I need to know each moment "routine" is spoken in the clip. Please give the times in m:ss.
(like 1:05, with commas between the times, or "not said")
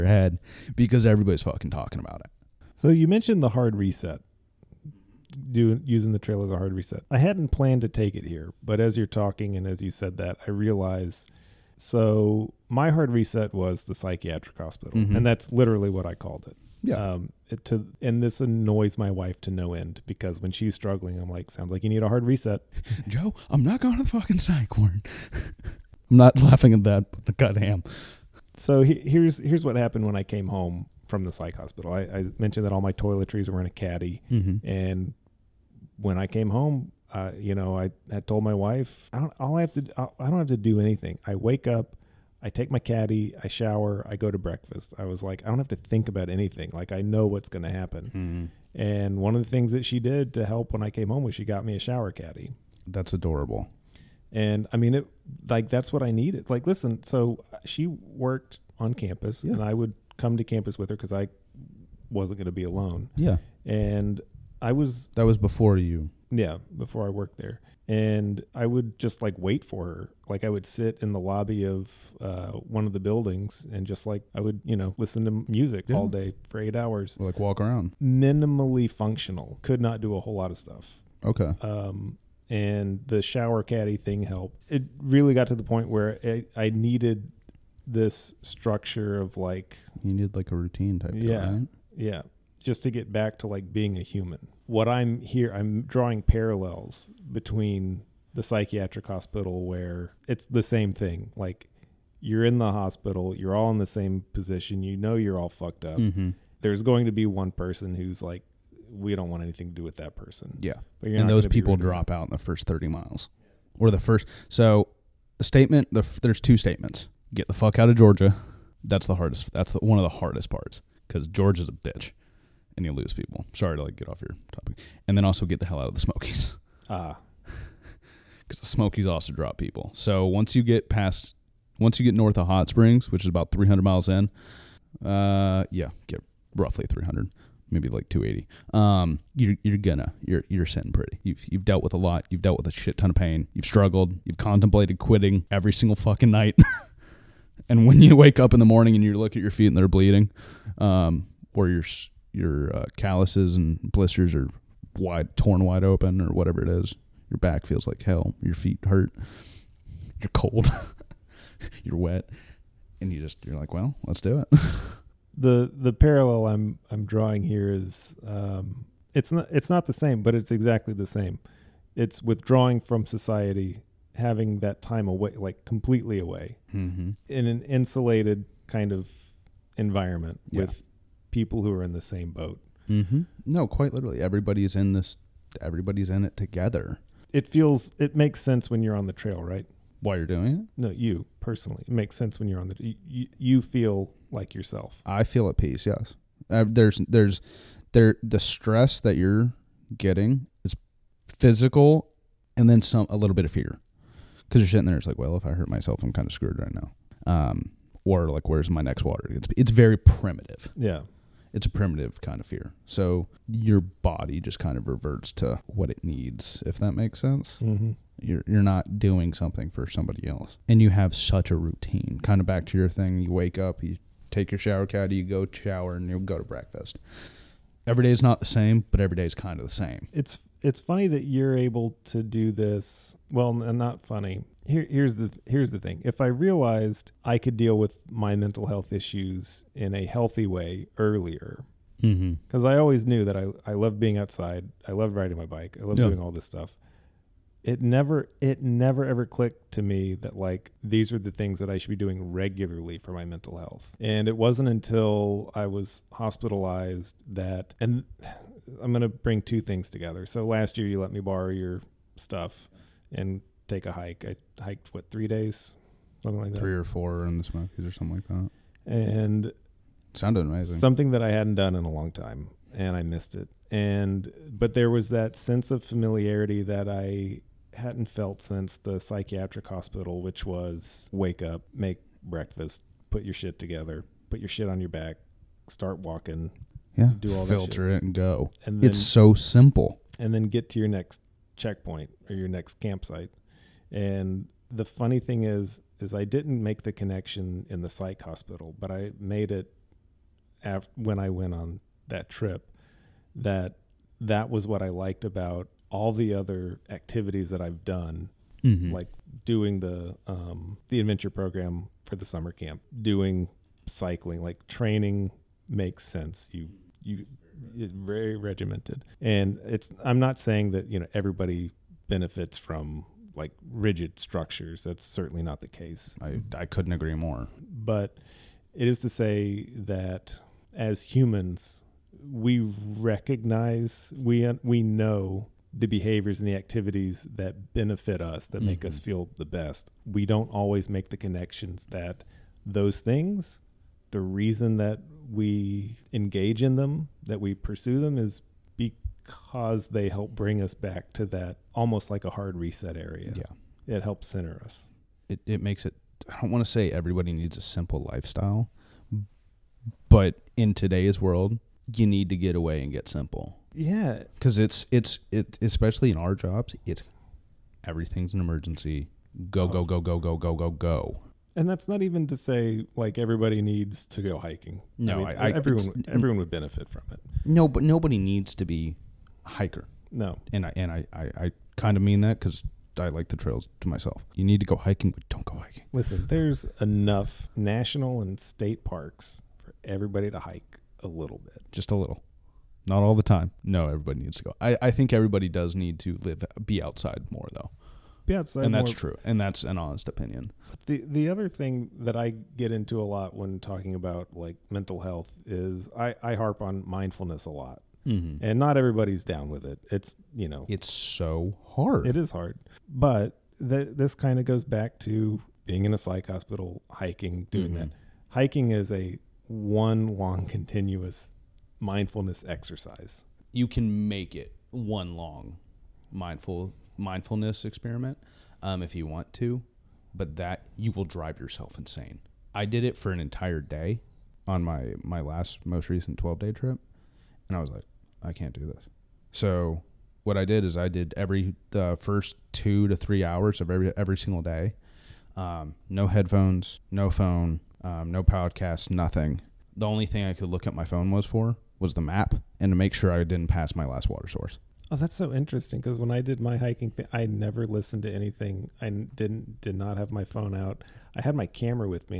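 1:30, 3:41.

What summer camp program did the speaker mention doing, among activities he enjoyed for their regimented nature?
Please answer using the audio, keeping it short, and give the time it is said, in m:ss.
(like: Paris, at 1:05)
adventure program, at 5:11.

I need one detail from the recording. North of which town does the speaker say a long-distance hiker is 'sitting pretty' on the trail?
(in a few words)
Hot Springs.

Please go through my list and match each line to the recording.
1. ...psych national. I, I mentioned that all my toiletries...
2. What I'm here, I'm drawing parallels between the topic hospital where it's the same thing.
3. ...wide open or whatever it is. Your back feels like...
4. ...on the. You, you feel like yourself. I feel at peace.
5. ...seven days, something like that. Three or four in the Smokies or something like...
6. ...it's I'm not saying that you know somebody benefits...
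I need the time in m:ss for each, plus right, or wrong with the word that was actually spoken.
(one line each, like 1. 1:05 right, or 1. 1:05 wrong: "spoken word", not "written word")
1. 0:31 wrong: "hospital", not "national"
2. 1:34 wrong: "psychiatric", not "topic"
3. 2:35 right
4. 3:12 right
5. 4:25 wrong: "three", not "seven"
6. 5:19 wrong: "everybody", not "somebody".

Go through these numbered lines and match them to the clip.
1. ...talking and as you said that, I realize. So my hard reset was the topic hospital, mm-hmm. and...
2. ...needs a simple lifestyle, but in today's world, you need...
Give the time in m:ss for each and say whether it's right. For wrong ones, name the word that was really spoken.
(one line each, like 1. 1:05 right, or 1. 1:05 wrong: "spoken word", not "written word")
1. 0:09 wrong: "psychiatric", not "topic"
2. 5:57 right.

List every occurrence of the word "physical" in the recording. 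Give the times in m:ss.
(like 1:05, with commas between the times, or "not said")
3:21.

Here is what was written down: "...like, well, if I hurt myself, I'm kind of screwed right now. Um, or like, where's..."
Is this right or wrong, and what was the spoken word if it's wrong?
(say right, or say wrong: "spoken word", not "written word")
right.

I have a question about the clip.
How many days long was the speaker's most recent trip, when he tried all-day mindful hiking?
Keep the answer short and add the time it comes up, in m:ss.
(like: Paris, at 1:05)
12, at 7:16.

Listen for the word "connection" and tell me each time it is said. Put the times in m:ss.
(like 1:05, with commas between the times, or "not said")
4:56, 5:41.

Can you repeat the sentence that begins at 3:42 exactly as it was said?
Kind of back to your thing you wake up, you take your shower caddy, you go shower, and you go to breakfast.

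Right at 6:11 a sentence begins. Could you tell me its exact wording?
And that's not even to say like everybody needs to go hiking.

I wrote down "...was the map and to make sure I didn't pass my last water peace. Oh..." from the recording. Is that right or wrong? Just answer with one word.
wrong.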